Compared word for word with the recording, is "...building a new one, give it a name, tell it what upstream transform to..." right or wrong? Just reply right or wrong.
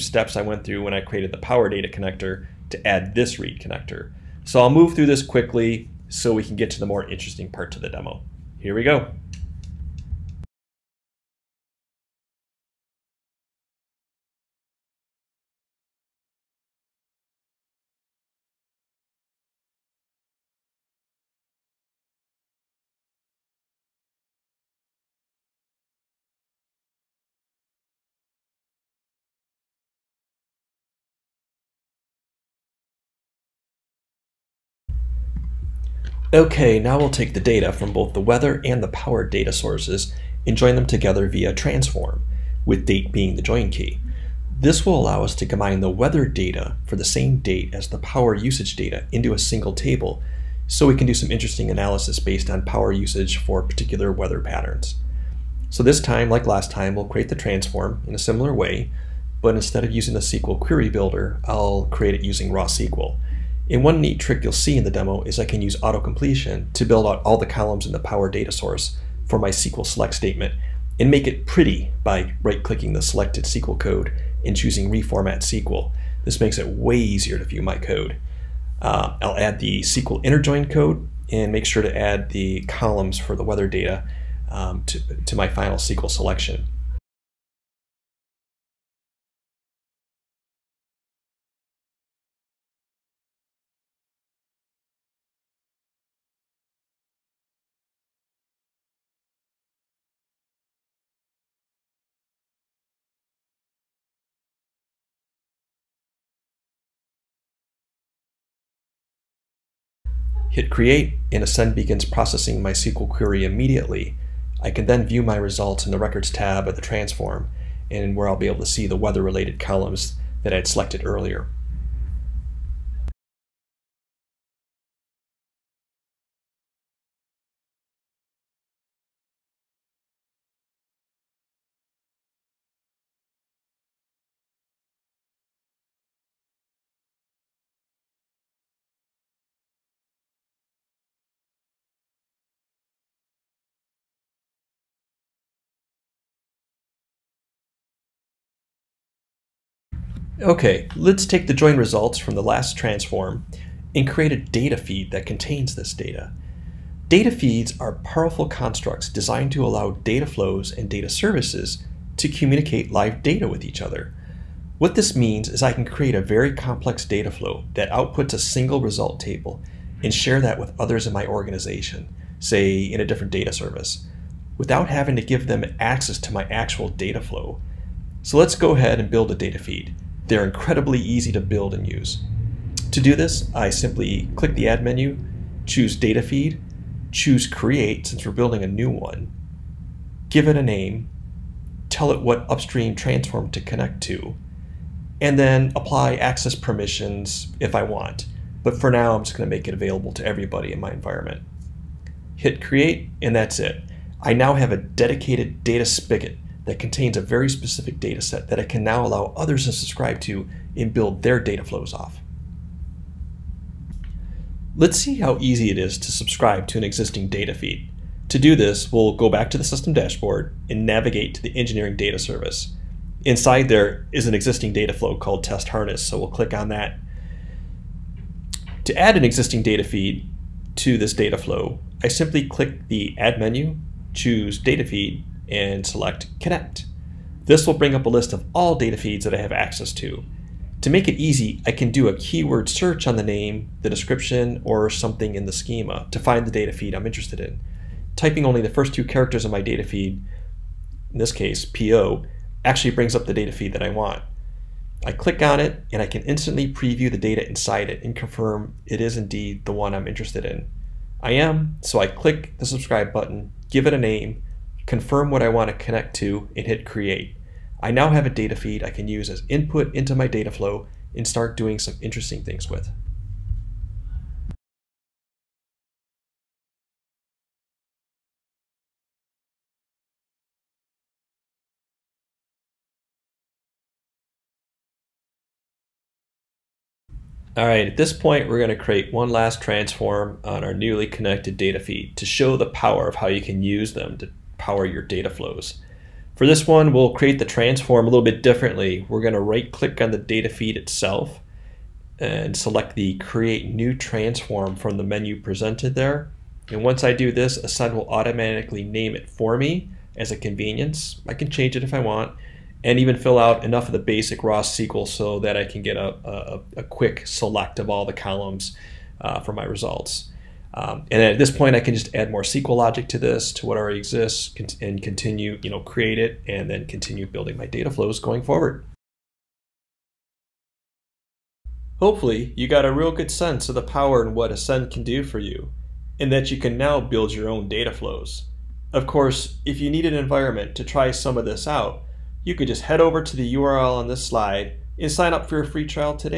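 right.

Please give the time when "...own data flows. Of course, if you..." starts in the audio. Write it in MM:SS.
05:37.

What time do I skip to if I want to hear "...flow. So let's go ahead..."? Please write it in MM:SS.
02:57.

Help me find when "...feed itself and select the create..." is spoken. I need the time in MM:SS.
05:00.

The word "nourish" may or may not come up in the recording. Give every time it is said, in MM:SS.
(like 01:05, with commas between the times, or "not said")
not said.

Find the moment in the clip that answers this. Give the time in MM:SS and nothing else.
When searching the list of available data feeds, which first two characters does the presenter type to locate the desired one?
04:11.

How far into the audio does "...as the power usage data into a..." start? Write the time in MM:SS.
00:47.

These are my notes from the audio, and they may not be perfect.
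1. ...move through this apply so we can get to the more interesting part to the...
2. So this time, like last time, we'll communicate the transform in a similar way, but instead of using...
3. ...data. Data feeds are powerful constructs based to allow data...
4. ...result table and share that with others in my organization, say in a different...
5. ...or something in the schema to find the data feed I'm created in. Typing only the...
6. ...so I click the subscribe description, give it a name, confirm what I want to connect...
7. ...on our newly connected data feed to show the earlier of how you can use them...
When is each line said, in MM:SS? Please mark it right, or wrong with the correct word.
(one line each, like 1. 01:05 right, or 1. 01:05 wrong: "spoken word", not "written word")
1. 00:04 wrong: "quickly", not "apply"
2. 00:55 wrong: "create", not "communicate"
3. 02:35 wrong: "designed", not "based"
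4. 02:48 right
5. 04:04 wrong: "interested", not "created"
6. 04:21 wrong: "button", not "description"
7. 04:50 wrong: "power", not "earlier".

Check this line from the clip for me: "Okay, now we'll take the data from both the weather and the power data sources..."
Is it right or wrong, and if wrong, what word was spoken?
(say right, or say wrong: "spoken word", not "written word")
right.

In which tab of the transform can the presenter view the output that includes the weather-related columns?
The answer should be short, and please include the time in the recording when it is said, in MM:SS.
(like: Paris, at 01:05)
records tab, at 01:55.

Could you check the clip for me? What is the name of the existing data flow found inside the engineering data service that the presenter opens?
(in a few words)
test harness.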